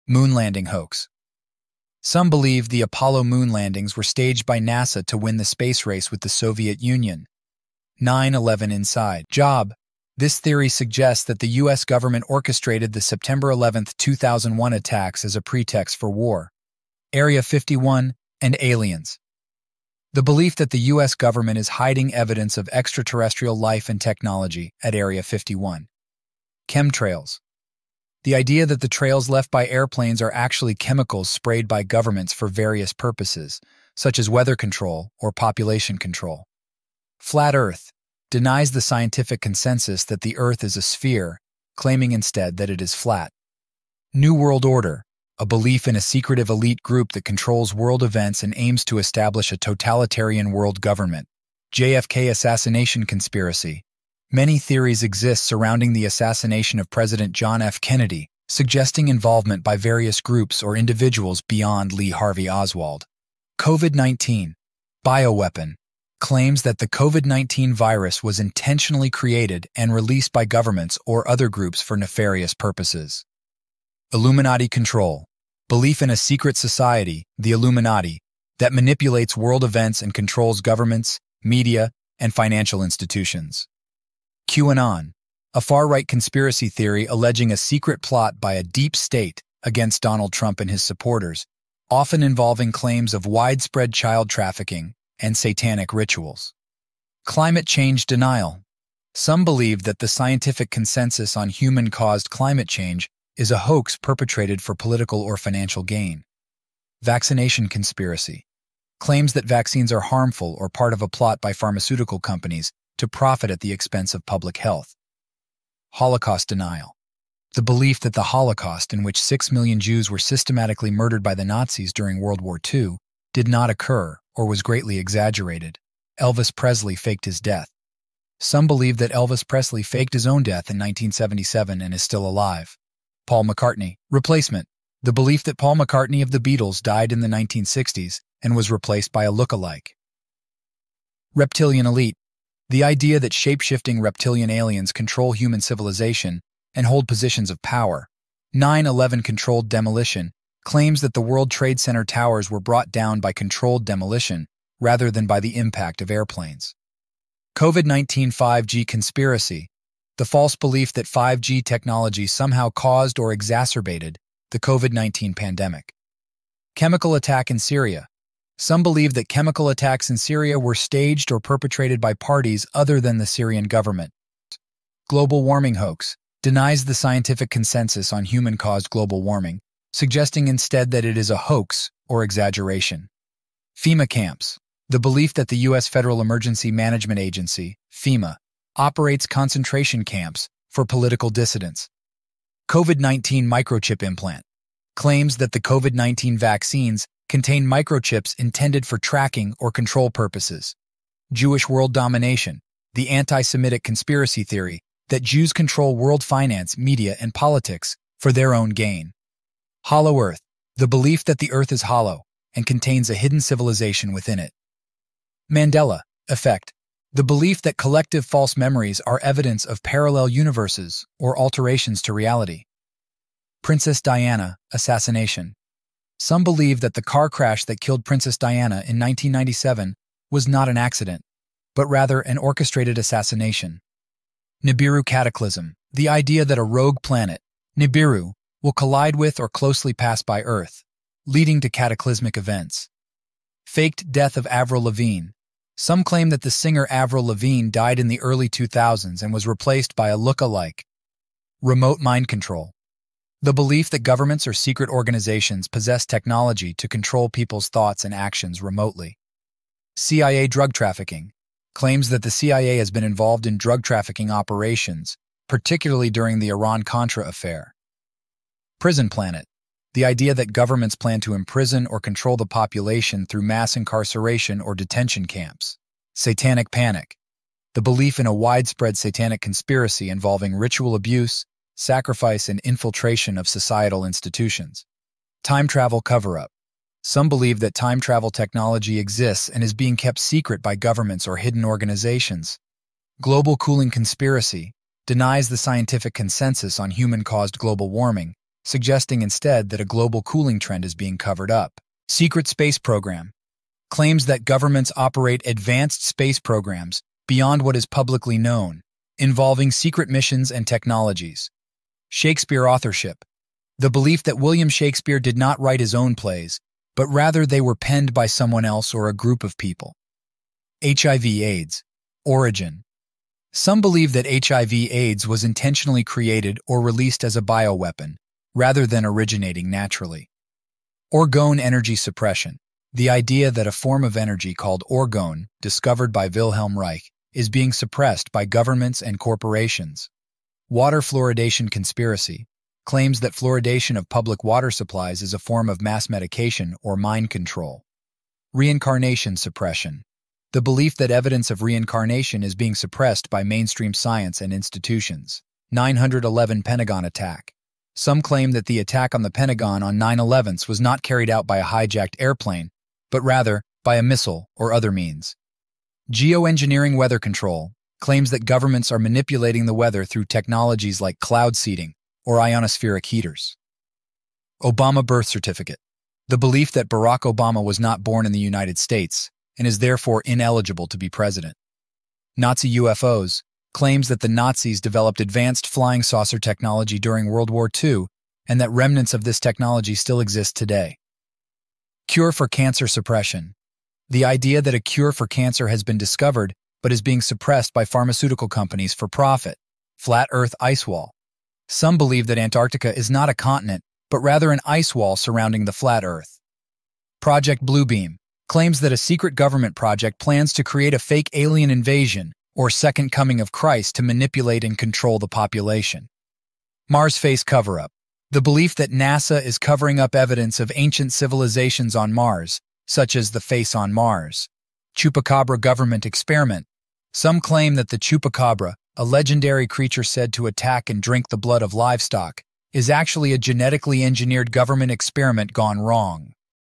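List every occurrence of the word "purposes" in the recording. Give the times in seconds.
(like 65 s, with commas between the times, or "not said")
32 s, 72 s, 200 s.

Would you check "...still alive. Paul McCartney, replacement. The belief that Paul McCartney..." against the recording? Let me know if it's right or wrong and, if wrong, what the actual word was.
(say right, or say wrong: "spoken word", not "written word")
right.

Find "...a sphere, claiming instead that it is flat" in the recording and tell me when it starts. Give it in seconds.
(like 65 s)
40 s.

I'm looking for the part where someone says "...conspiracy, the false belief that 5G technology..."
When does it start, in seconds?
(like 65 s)
158 s.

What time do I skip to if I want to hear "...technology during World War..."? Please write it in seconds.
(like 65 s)
386 s.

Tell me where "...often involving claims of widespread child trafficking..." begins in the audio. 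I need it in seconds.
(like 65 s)
91 s.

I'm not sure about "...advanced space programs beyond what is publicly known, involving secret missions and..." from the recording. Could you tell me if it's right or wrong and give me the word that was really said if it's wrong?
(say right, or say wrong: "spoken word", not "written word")
right.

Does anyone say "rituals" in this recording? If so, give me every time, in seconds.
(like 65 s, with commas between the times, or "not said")
95 s, 280 s.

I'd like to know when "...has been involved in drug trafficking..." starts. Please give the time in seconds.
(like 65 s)
262 s.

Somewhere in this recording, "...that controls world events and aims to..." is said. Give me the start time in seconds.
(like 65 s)
47 s.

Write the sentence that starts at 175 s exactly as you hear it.
Global warming hoax denies the scientific consensus on human-caused global warming, suggesting instead that it is a hoax or exaggeration.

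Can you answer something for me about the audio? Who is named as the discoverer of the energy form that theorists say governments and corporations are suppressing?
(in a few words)
Wilhelm Reich.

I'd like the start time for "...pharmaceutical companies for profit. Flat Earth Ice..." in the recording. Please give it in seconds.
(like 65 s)
397 s.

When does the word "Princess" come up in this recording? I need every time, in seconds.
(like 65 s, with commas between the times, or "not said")
223 s, 228 s.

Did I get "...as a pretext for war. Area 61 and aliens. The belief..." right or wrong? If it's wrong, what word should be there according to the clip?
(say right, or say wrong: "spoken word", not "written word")
wrong: "51", not "61".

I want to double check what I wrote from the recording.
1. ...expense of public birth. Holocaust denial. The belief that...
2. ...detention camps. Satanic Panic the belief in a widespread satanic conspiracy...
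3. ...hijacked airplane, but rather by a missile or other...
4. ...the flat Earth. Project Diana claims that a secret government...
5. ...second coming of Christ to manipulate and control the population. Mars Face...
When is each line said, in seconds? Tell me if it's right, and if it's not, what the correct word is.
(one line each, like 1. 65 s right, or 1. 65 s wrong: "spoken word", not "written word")
1. 113 s wrong: "health", not "birth"
2. 274 s right
3. 361 s right
4. 405 s wrong: "Bluebeam", not "Diana"
5. 412 s right.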